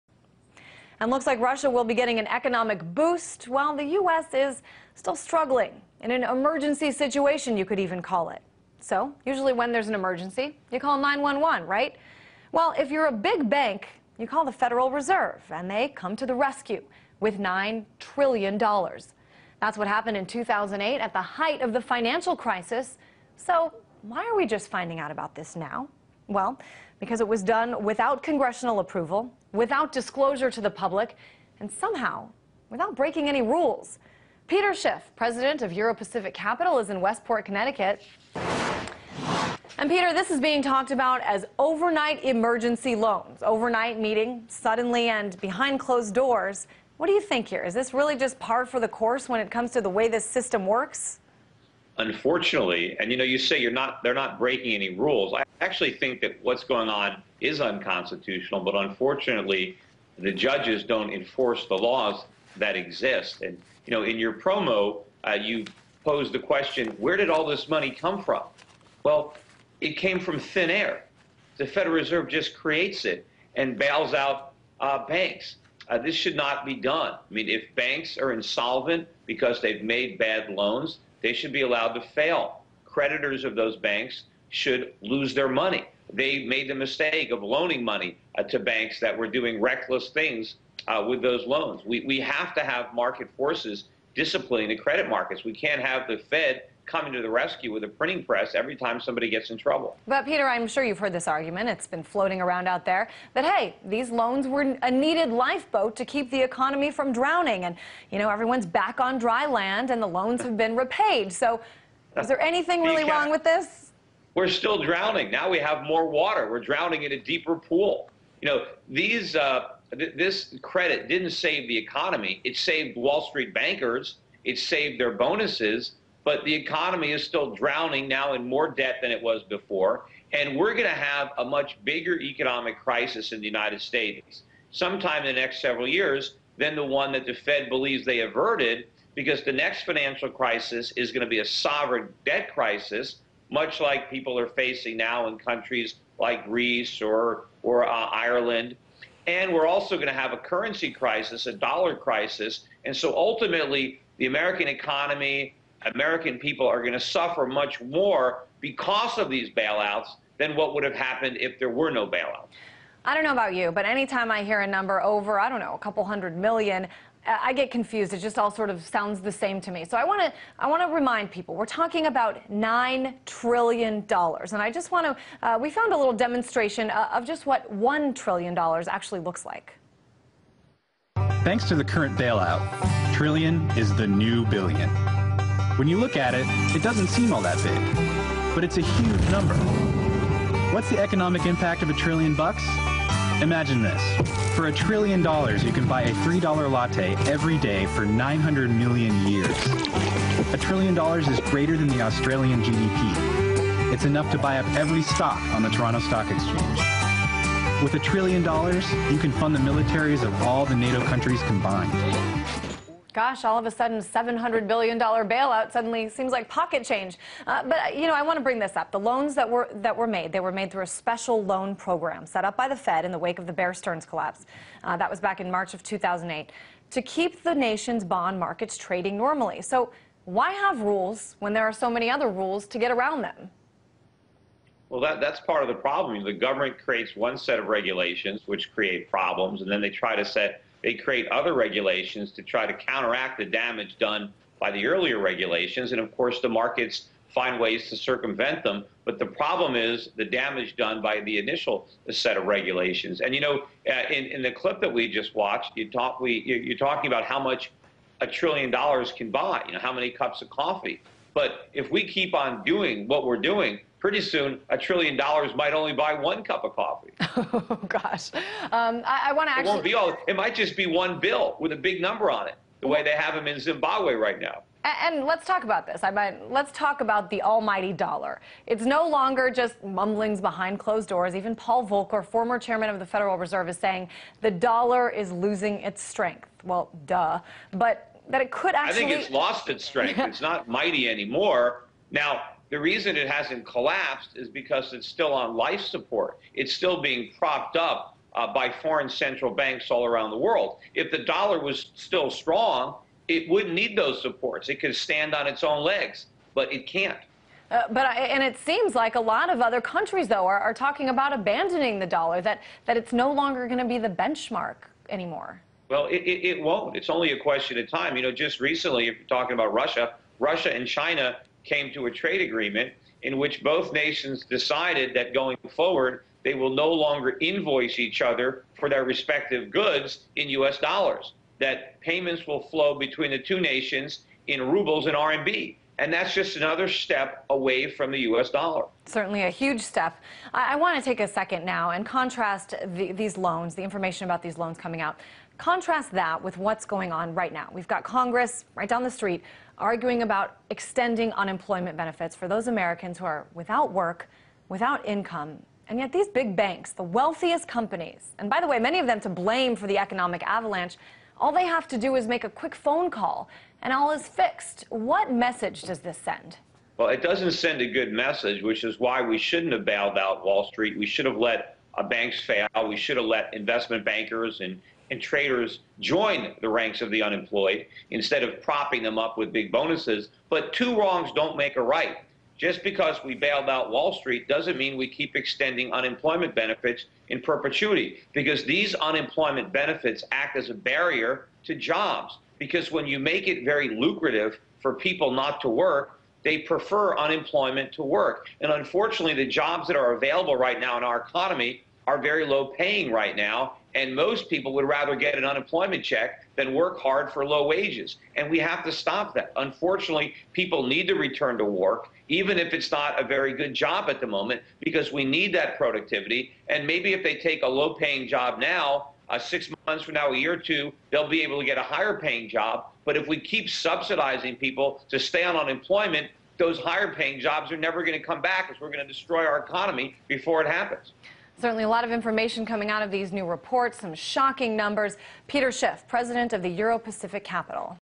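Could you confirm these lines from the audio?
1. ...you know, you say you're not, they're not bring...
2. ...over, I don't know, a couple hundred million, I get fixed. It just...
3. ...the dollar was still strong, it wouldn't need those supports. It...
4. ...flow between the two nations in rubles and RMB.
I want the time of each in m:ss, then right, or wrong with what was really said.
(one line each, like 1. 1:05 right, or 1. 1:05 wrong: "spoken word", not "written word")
1. 0:53 wrong: "breaking", not "bring"
2. 2:45 wrong: "confused", not "fixed"
3. 5:01 right
4. 5:32 right.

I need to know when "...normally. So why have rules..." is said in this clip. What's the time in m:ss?
3:49.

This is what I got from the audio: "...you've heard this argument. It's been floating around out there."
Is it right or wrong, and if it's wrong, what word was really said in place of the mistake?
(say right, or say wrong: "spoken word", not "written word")
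right.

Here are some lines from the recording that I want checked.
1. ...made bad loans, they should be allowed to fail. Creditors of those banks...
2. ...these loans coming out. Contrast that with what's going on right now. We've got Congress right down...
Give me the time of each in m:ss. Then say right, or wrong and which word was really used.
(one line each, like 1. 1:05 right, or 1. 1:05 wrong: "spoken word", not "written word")
1. 1:19 right
2. 5:44 right.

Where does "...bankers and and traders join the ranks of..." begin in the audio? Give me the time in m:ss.
6:14.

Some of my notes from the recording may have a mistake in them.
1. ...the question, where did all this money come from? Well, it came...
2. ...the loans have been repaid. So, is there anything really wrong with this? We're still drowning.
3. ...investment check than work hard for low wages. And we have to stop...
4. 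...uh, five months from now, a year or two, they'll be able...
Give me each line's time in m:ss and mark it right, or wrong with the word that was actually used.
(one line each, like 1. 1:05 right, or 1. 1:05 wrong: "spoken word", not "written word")
1. 1:06 right
2. 1:50 right
3. 6:45 wrong: "unemployment", not "investment"
4. 6:59 wrong: "six", not "five".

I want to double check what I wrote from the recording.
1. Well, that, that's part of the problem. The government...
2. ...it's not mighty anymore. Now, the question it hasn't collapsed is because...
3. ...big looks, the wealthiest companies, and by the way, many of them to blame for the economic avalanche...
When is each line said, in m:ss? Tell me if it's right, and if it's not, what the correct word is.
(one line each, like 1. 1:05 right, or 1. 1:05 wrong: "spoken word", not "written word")
1. 3:54 right
2. 4:50 wrong: "reason", not "question"
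3. 5:56 wrong: "banks", not "looks".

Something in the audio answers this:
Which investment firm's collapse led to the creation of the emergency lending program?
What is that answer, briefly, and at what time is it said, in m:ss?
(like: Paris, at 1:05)
Bear Stearns, at 3:43.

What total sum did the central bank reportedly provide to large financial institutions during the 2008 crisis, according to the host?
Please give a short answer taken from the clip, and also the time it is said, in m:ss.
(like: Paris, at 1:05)
$9 trillion, at 0:17.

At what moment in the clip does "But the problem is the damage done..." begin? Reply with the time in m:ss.
4:09.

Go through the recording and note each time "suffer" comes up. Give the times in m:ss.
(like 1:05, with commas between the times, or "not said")
2:36.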